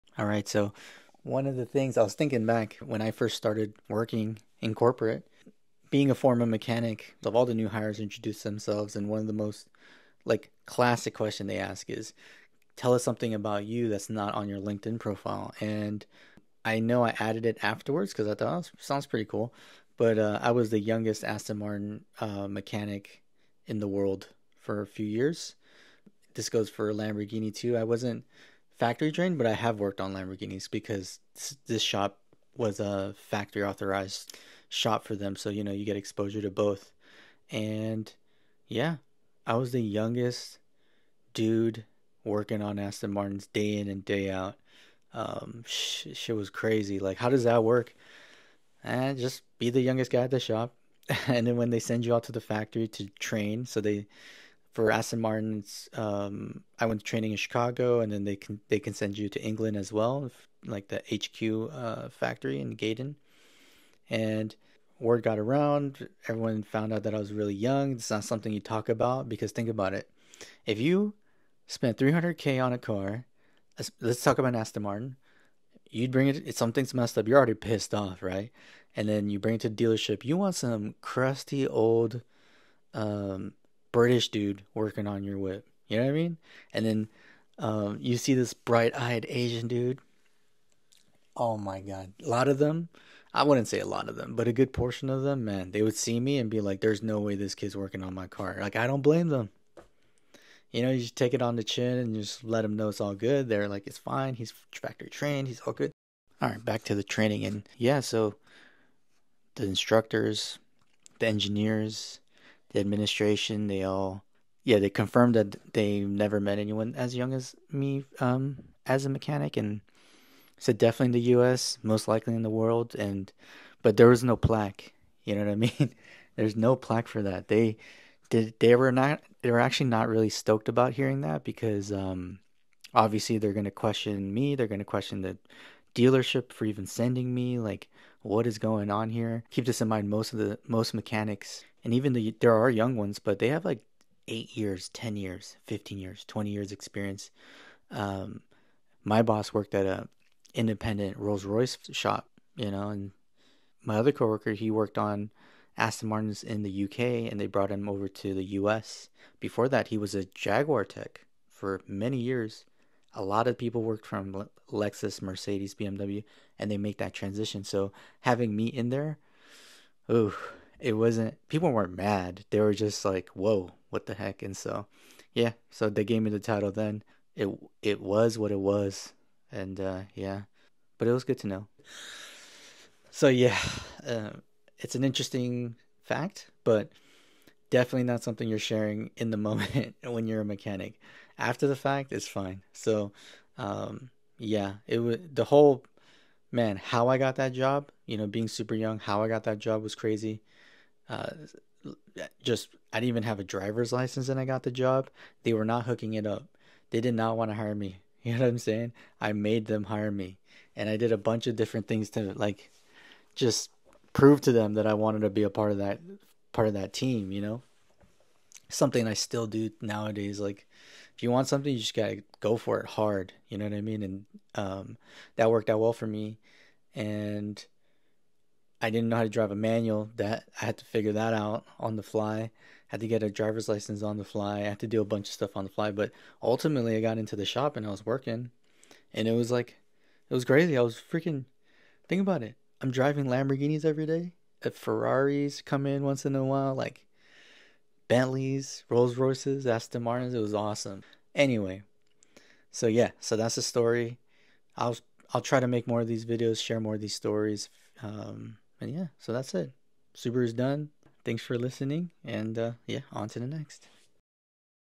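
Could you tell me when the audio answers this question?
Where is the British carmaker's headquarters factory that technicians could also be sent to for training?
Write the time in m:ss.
1:02.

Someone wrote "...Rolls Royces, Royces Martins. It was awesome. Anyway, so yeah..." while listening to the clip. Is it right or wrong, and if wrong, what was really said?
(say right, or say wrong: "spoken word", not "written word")
wrong: "Aston", not "Royces".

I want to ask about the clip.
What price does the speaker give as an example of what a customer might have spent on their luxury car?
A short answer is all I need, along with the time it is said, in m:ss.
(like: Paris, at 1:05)
300k, at 1:11.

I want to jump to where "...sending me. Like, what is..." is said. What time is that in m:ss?
2:16.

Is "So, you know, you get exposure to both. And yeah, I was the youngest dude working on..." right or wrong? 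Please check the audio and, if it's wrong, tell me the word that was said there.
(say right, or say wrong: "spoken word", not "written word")
right.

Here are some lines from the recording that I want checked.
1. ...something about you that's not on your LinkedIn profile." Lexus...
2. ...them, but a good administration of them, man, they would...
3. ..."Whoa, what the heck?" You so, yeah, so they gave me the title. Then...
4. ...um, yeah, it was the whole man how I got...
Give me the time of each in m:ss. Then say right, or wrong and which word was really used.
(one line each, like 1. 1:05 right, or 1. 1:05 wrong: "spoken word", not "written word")
1. 0:13 wrong: "And", not "Lexus"
2. 1:34 wrong: "portion", not "administration"
3. 2:53 wrong: "And", not "You"
4. 3:13 right.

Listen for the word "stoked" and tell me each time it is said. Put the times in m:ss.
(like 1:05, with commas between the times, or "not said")
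2:10.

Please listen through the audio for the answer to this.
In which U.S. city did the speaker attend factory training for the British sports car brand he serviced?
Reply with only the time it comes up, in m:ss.
0:57.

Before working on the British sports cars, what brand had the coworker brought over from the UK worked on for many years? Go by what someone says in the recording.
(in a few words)
Jaguar.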